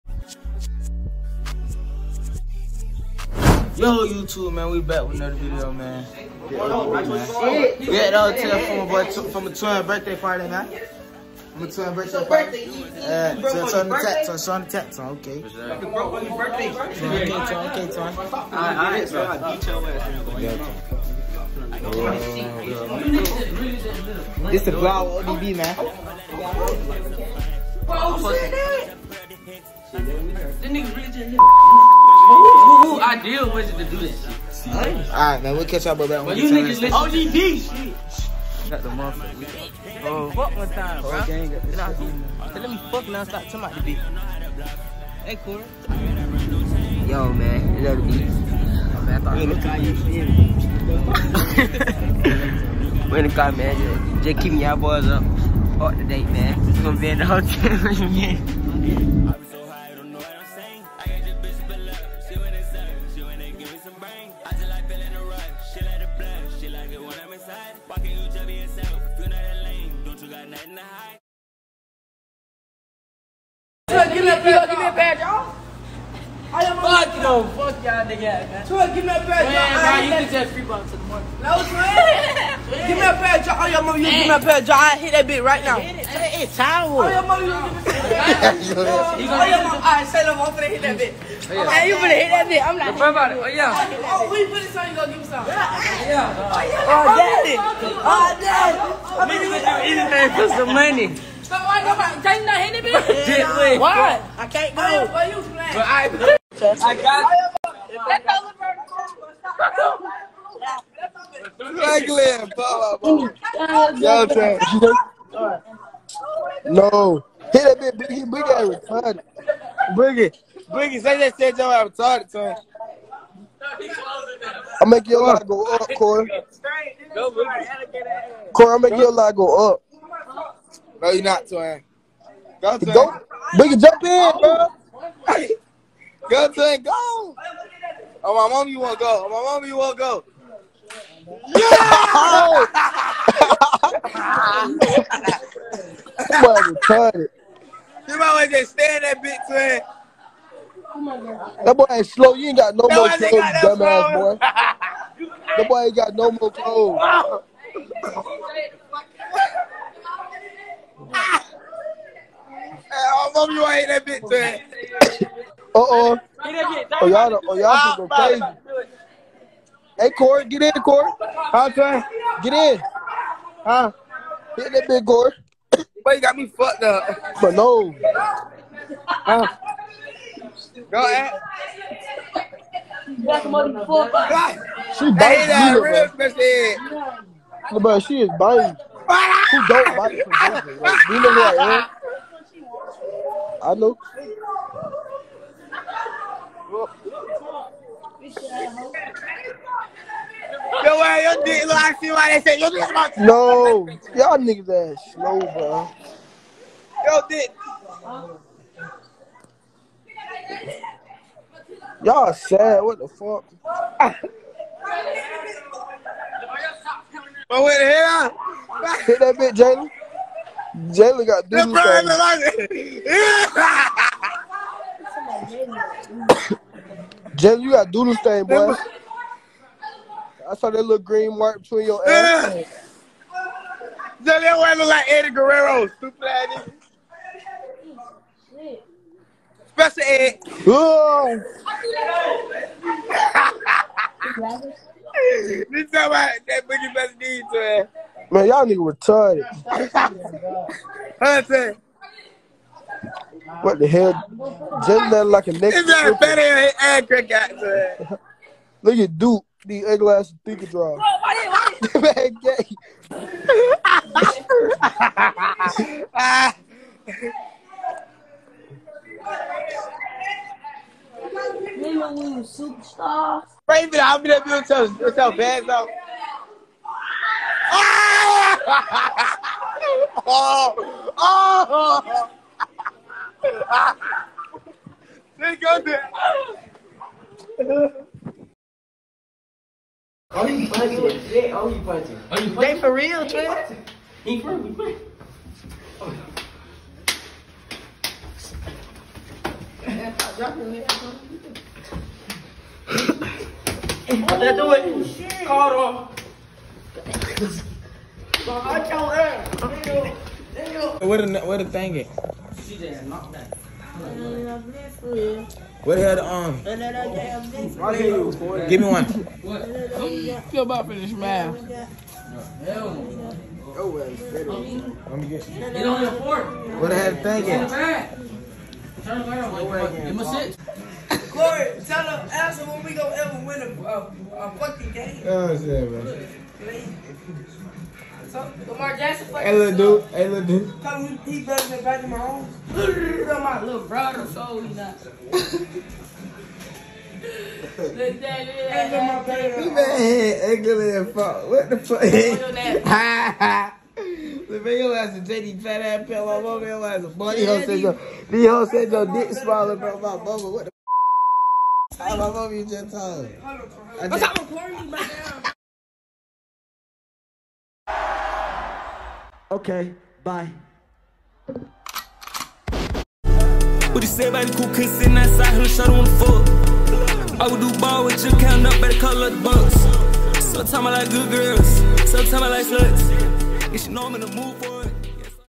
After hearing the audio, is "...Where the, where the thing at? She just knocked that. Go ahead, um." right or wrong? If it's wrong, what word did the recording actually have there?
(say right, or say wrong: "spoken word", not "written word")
right.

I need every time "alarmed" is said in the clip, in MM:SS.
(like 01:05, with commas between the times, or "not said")
not said.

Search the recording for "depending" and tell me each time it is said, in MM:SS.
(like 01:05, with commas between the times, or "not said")
not said.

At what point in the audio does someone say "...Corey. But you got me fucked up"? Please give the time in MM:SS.
02:55.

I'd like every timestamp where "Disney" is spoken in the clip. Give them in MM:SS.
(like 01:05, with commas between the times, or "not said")
03:42.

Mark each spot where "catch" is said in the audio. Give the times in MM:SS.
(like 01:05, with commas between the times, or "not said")
00:35.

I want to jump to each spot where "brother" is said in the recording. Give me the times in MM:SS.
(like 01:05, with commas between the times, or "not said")
04:45, 05:43.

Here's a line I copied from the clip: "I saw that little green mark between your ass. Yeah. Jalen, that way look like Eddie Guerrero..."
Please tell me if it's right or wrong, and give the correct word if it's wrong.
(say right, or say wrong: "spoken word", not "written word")
right.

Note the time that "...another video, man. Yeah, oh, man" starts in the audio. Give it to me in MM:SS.
00:05.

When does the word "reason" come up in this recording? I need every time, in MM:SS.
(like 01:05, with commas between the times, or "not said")
not said.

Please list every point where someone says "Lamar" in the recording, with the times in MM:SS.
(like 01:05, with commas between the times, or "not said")
05:38.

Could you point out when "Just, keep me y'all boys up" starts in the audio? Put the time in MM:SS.
00:54.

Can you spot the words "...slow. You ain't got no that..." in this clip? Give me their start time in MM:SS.
02:32.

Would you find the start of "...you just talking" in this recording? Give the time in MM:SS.
06:02.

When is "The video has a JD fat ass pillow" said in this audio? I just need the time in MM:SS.
05:53.